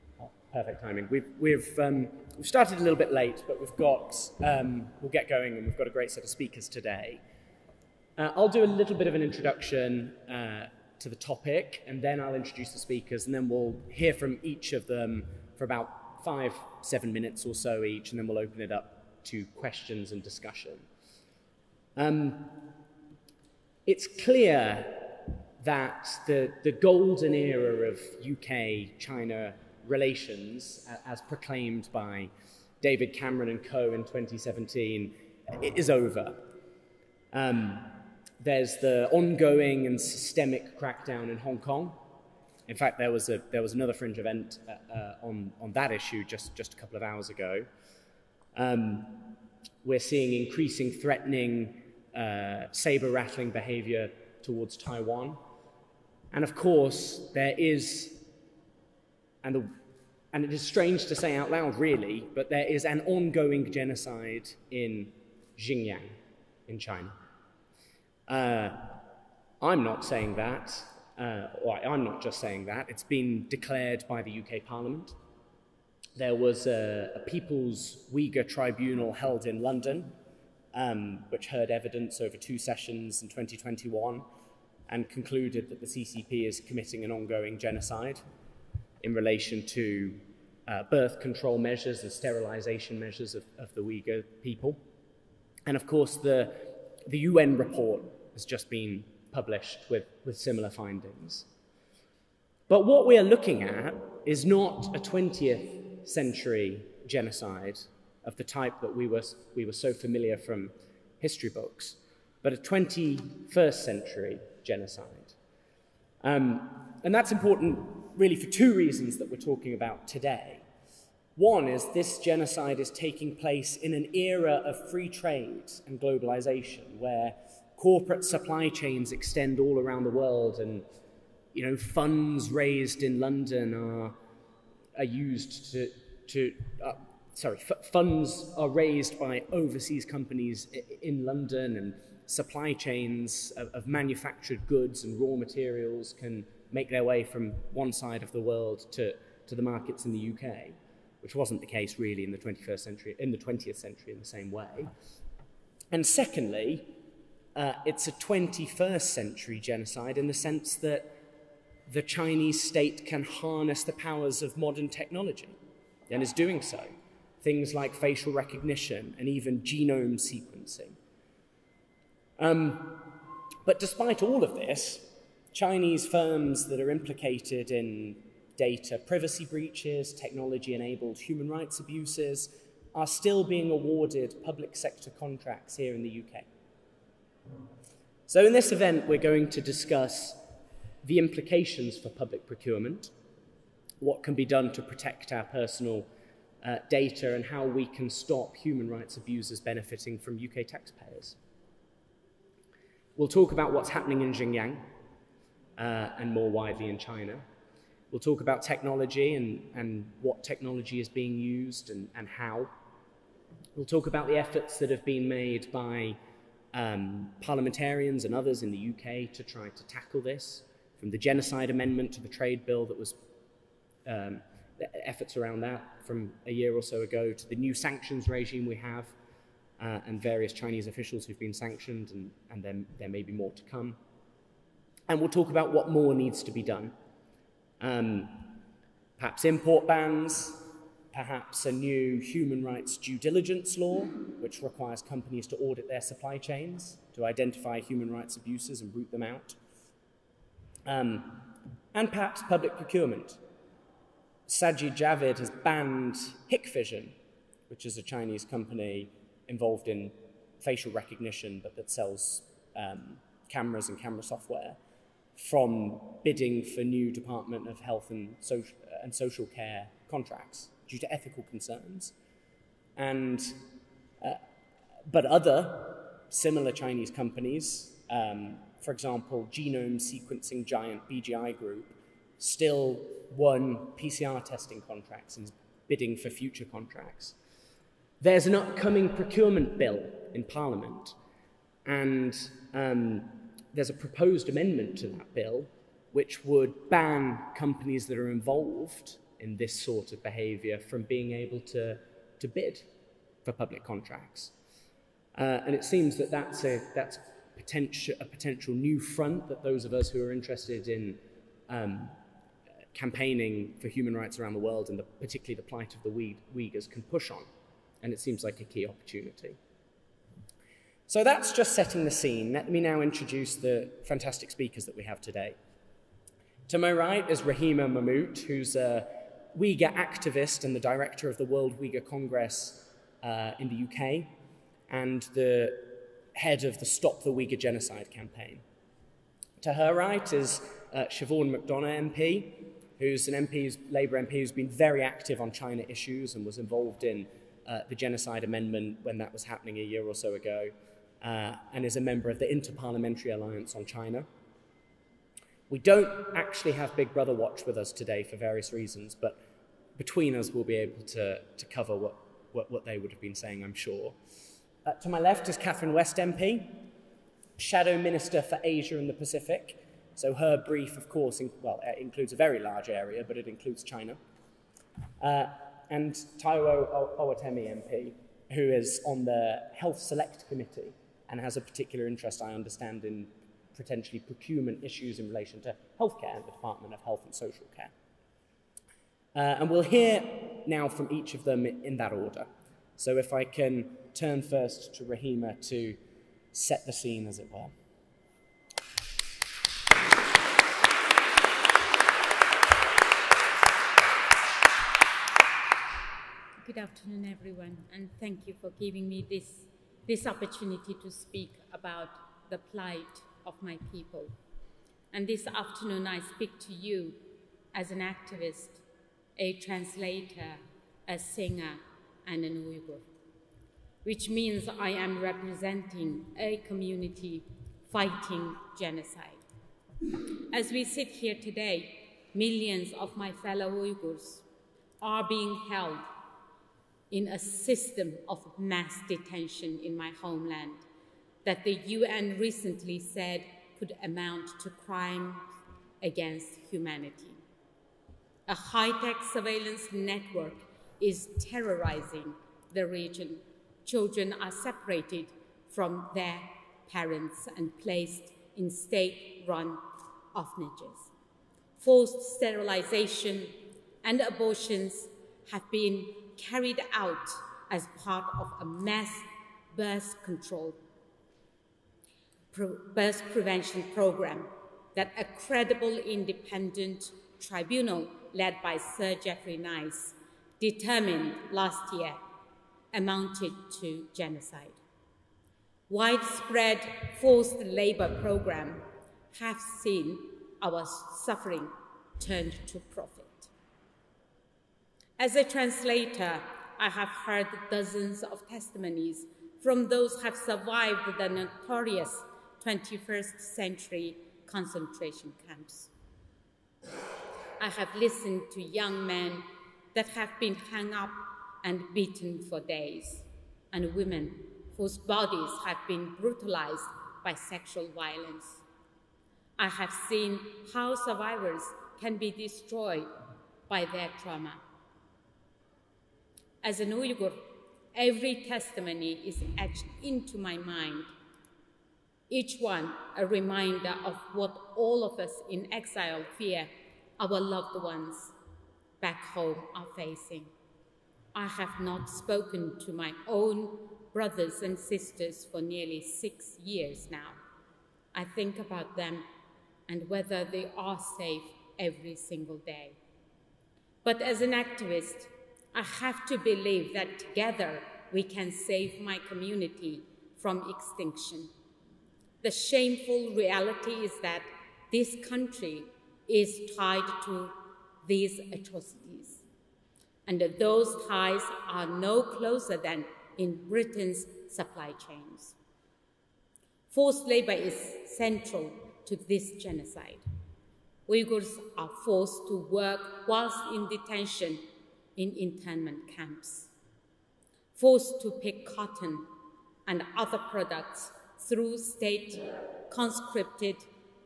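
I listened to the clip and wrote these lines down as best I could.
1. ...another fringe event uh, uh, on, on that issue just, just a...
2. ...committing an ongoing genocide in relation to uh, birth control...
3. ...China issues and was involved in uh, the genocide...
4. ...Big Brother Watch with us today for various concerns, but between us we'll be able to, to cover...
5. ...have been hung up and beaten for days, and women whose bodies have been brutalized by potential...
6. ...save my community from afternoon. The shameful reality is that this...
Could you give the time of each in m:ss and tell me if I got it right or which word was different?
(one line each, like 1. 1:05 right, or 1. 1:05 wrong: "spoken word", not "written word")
1. 0:43 right
2. 1:26 right
3. 5:45 right
4. 5:56 wrong: "reasons", not "concerns"
5. 8:30 wrong: "sexual", not "potential"
6. 9:18 wrong: "extinction", not "afternoon".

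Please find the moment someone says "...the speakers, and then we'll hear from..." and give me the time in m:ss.
0:12.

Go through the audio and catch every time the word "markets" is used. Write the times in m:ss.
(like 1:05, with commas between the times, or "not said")
2:29.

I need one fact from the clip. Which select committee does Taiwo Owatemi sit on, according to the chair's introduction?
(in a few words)
Health Select Committee.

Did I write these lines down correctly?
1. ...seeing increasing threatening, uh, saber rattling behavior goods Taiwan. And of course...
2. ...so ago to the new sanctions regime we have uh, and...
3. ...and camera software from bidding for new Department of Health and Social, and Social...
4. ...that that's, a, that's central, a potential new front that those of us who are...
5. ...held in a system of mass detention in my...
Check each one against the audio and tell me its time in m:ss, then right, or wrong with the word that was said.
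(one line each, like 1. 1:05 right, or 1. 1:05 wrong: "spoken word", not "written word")
1. 0:49 wrong: "towards", not "goods"
2. 3:46 right
3. 4:23 right
4. 5:06 wrong: "potential", not "central"
5. 7:15 right.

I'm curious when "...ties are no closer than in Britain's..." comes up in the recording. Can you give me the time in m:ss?
9:31.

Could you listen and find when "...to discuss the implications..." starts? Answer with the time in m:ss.
3:09.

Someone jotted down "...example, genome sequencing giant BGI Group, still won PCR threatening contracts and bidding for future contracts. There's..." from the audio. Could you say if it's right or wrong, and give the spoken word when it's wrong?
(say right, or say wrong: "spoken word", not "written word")
wrong: "testing", not "threatening".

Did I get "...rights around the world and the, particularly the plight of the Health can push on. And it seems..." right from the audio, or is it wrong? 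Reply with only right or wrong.
wrong.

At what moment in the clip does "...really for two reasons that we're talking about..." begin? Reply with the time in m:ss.
1:58.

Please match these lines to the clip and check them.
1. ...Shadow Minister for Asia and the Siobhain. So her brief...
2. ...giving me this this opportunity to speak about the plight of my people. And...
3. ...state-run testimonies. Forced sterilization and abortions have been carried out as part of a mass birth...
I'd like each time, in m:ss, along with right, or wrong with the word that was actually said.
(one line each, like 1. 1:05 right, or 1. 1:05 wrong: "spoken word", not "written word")
1. 6:07 wrong: "Pacific", not "Siobhain"
2. 6:48 right
3. 7:38 wrong: "orphanages", not "testimonies".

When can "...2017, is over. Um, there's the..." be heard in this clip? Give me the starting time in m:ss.
0:34.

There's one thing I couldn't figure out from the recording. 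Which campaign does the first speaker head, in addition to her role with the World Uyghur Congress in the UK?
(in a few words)
Stop the Uyghur Genocide.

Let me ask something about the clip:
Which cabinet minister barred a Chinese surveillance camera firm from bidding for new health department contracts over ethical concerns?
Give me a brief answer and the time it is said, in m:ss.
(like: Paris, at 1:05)
Sajid Javid, at 4:14.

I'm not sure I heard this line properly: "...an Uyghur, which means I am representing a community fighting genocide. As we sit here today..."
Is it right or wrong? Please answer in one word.
right.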